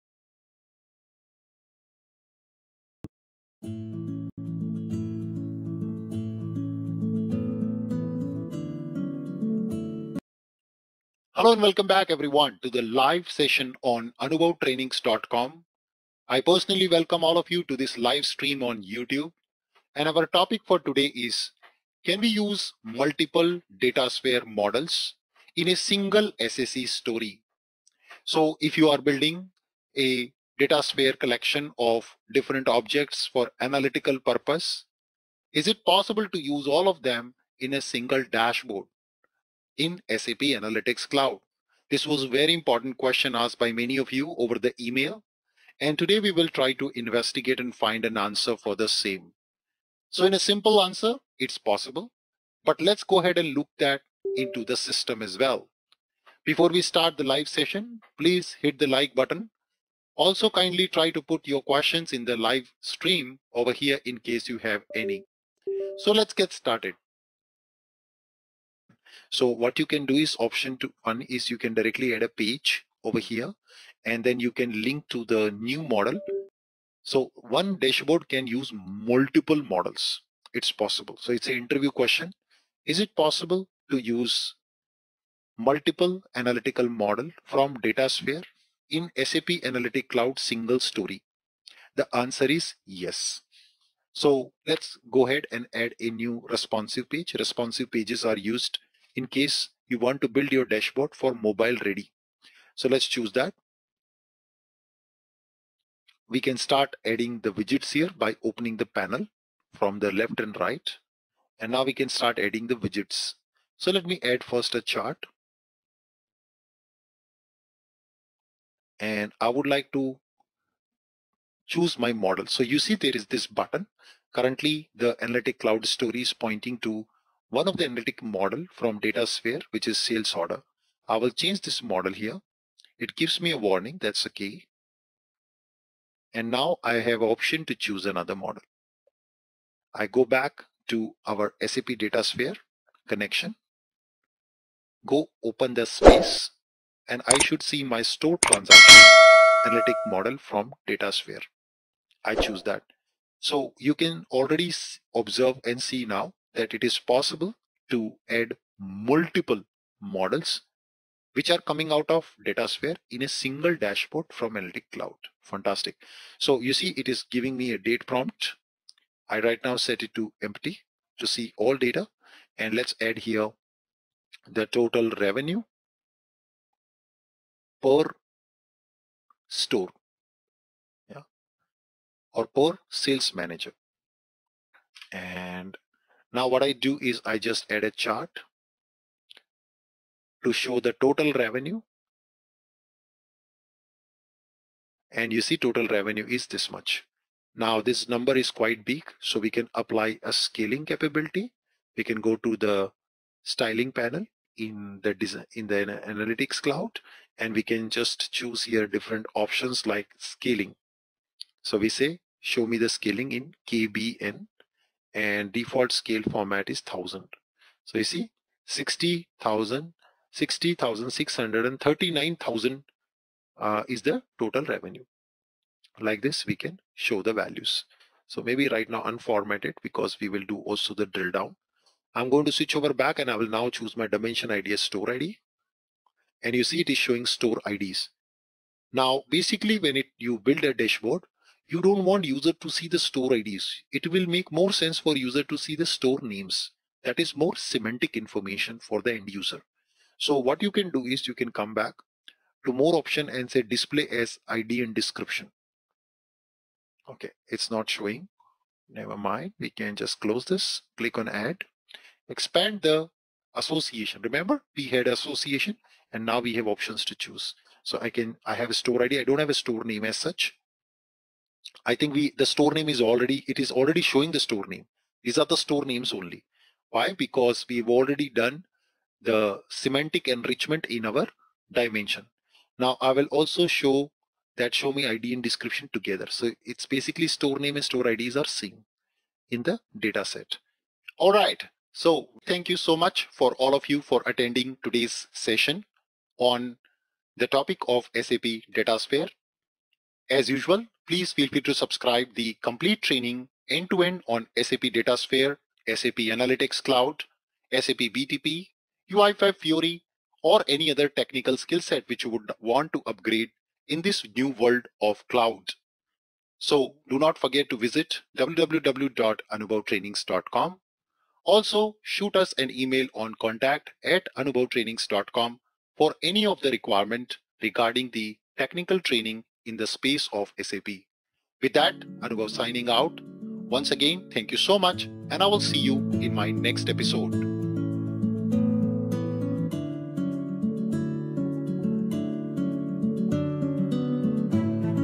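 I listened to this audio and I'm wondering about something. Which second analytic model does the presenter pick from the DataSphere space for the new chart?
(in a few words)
Store transaction.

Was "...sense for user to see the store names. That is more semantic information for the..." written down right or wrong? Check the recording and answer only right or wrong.
right.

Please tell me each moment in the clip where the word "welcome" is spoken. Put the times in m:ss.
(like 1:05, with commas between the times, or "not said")
0:11, 0:16.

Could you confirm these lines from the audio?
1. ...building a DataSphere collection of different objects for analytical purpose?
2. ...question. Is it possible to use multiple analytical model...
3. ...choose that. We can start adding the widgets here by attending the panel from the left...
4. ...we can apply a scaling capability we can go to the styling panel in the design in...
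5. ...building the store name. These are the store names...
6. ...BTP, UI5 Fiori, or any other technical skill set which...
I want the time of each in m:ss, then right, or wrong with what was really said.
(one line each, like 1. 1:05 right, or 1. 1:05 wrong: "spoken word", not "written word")
1. 0:28 right
2. 1:21 right
3. 1:43 wrong: "opening", not "attending"
4. 3:19 right
5. 4:34 wrong: "showing", not "building"
6. 5:08 right.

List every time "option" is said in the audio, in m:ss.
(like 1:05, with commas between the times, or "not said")
1:10, 2:17, 3:29, 4:12, 4:26.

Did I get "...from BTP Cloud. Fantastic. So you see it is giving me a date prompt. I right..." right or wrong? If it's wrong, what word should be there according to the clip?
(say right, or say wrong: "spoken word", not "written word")
wrong: "Analytic", not "BTP".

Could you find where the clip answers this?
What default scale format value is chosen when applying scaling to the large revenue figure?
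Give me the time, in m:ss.
3:36.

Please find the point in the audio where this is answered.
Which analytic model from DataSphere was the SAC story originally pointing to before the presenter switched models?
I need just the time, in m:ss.
2:09.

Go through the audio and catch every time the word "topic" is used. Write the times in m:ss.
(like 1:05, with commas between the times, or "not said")
0:20, 4:57.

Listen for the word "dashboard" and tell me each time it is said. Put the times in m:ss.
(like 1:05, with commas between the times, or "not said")
0:38, 1:17, 1:40, 2:43, 4:00.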